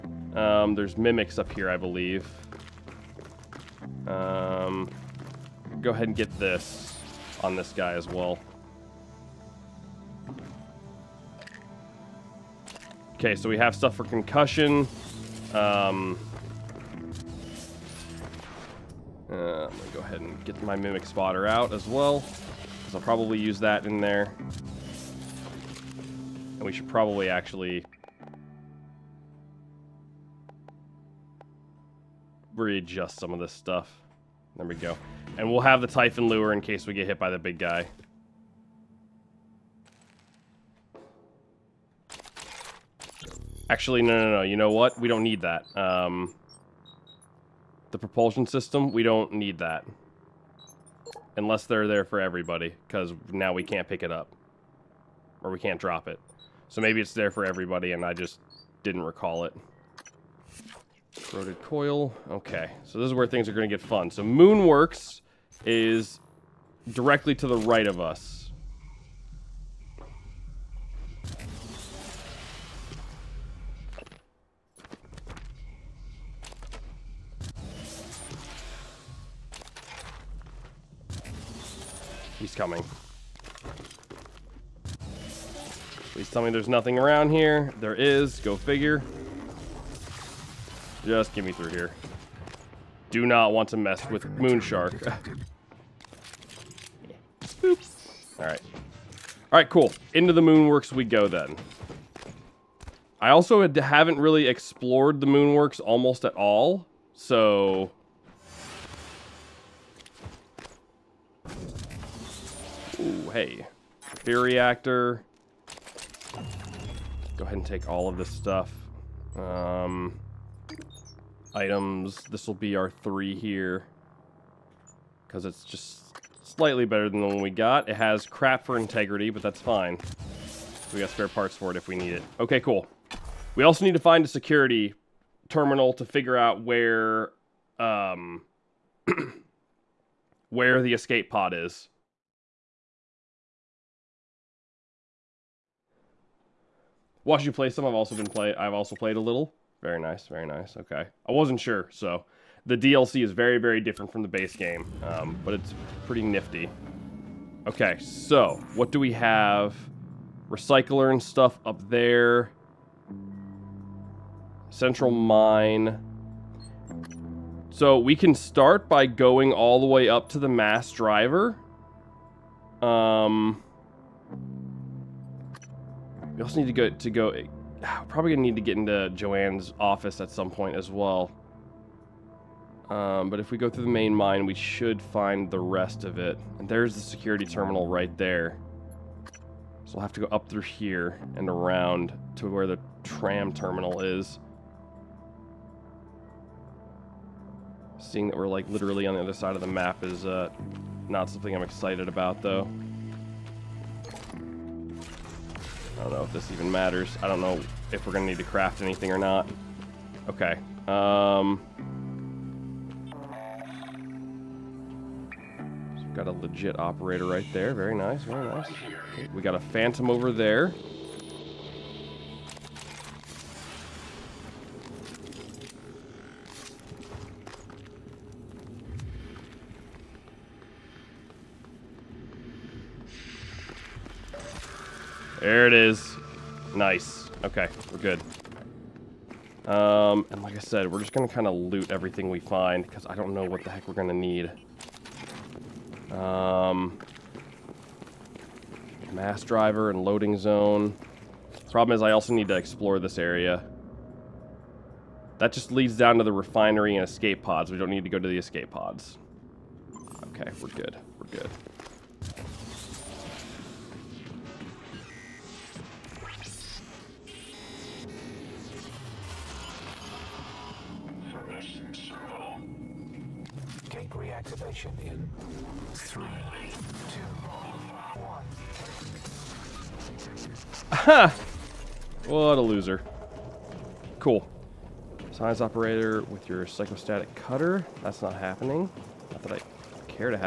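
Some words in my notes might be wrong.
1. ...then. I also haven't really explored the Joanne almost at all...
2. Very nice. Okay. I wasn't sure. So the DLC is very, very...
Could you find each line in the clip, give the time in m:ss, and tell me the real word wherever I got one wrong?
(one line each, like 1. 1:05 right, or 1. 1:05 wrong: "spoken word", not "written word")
1. 1:41 wrong: "Moonworks", not "Joanne"
2. 2:30 right.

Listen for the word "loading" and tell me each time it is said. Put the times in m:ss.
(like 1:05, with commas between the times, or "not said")
4:10.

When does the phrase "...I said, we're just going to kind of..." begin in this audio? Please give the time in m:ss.
4:00.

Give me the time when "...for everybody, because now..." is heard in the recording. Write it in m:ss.
0:52.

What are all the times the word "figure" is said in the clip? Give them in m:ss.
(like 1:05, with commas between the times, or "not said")
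1:28, 2:16.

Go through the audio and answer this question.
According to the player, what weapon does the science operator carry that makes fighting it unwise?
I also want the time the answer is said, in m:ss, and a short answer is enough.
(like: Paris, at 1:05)
psychostatic cutter, at 4:46.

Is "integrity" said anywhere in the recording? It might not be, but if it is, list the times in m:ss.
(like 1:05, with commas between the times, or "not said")
2:08.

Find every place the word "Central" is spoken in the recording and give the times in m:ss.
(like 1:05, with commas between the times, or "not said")
2:44.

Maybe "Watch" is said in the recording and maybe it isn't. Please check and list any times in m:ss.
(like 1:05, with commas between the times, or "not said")
2:27.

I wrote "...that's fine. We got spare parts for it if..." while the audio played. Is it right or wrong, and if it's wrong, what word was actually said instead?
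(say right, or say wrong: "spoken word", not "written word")
right.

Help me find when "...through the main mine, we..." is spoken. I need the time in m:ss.
3:03.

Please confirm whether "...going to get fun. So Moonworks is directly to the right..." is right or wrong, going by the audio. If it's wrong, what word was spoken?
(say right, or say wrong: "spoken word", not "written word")
right.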